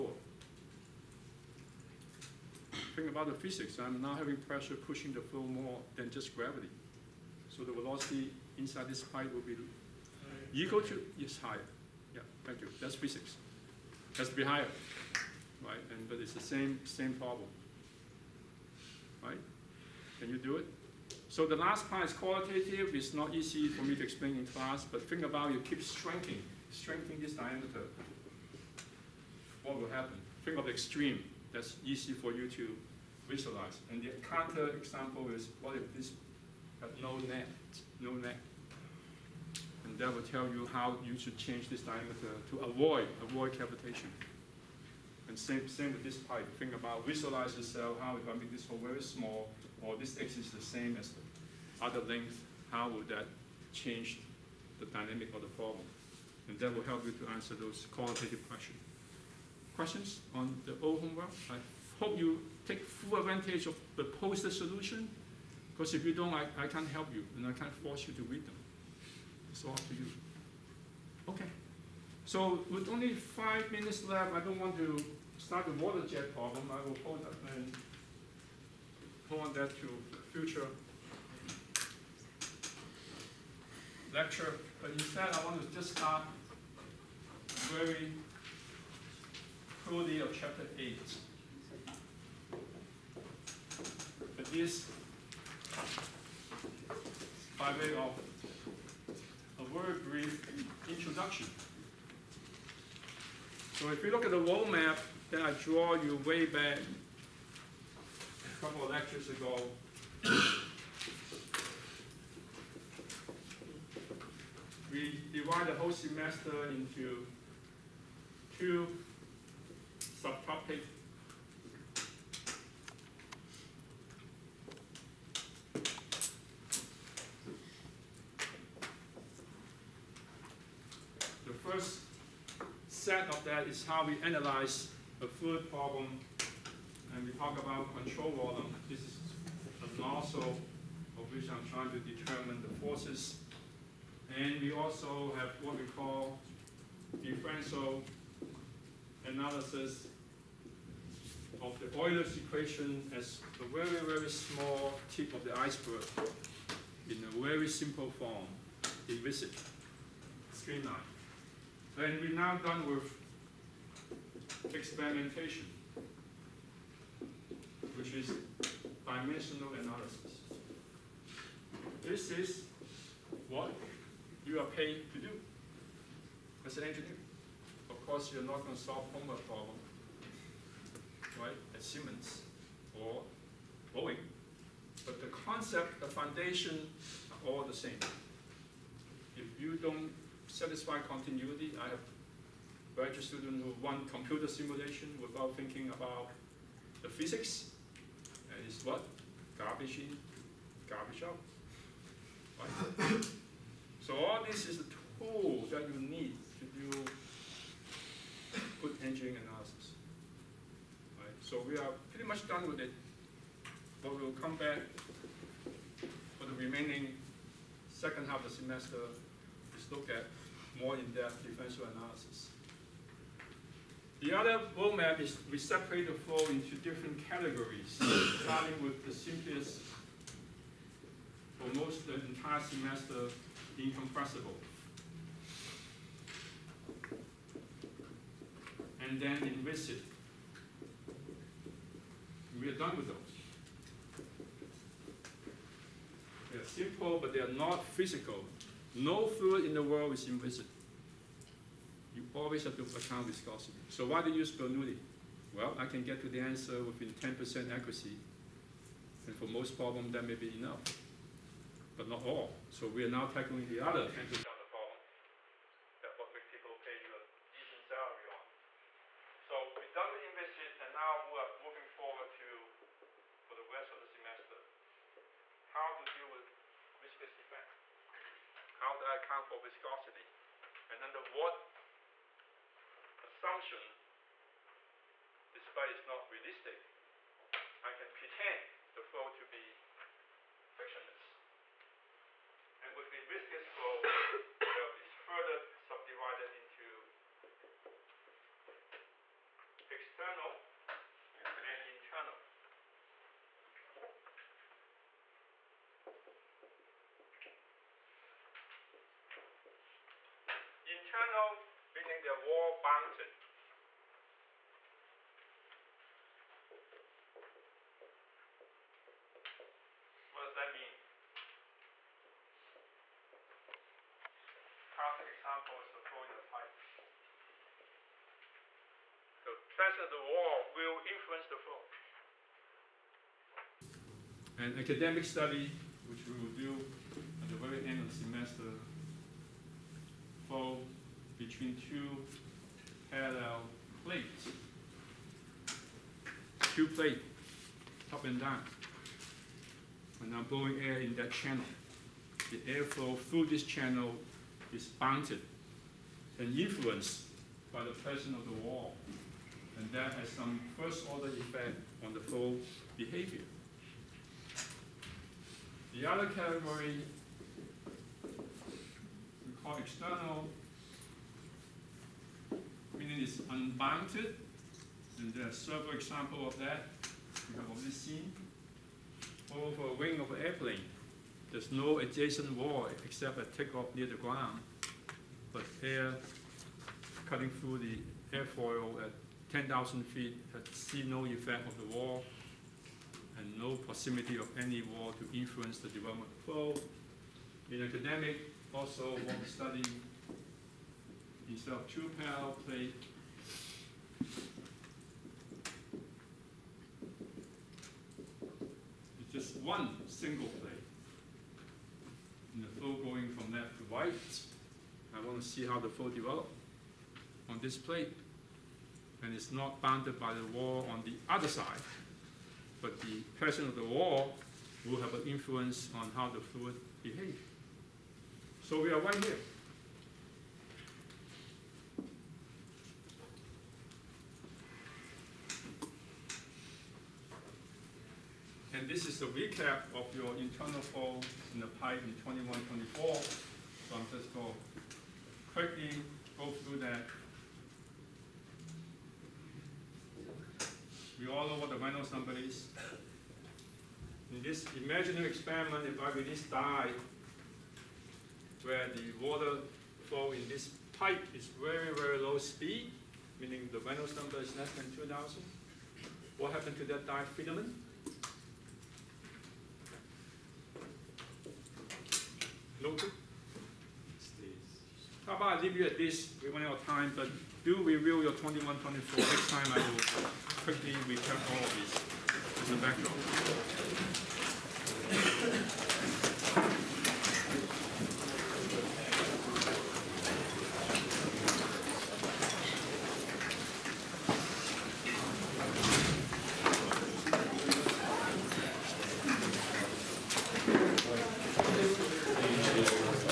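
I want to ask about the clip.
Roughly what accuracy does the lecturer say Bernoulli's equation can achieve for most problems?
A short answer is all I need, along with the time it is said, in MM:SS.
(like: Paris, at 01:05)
Within 10%, at 04:16.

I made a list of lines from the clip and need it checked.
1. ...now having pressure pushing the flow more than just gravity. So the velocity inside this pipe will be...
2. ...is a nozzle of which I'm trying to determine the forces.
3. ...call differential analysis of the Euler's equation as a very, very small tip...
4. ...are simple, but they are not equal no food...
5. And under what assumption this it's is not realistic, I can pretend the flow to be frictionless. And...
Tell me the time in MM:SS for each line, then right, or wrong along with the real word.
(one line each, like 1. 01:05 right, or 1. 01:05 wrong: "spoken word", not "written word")
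1. 00:04 right
2. 02:18 right
3. 02:25 right
4. 04:06 wrong: "physical", not "equal"
5. 04:40 right.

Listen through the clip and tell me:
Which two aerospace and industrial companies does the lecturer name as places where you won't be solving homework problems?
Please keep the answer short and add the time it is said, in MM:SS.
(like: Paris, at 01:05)
Siemens or Boeing, at 03:01.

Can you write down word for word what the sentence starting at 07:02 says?
But the pressure of the wall will have an influence on how the fluid behaves.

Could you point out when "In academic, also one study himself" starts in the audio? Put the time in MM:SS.
06:37.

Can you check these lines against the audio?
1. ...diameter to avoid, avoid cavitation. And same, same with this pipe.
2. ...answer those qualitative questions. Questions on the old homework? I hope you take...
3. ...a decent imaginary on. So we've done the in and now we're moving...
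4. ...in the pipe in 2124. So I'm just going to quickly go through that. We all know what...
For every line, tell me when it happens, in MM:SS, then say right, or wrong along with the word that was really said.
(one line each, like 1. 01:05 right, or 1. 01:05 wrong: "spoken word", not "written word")
1. 00:41 right
2. 00:57 right
3. 04:27 wrong: "salary", not "imaginary"
4. 07:21 right.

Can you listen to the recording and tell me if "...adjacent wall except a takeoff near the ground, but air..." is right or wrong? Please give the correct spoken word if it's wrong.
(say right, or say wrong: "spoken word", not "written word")
right.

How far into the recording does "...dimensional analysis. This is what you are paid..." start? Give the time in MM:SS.
02:49.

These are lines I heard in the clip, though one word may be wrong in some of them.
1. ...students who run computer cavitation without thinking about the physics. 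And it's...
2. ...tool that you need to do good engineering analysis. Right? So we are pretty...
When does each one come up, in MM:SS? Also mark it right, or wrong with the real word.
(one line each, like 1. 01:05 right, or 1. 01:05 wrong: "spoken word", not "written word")
1. 03:13 wrong: "simulation", not "cavitation"
2. 03:25 right.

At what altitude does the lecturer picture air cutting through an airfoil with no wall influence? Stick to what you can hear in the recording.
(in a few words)
10,000 feet.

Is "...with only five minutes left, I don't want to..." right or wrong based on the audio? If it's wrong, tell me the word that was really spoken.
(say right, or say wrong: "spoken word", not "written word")
right.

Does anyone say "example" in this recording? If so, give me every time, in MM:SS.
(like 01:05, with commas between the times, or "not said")
00:34, 05:25, 06:15.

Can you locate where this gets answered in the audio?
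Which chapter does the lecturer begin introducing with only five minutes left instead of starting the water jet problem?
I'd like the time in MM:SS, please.
01:30.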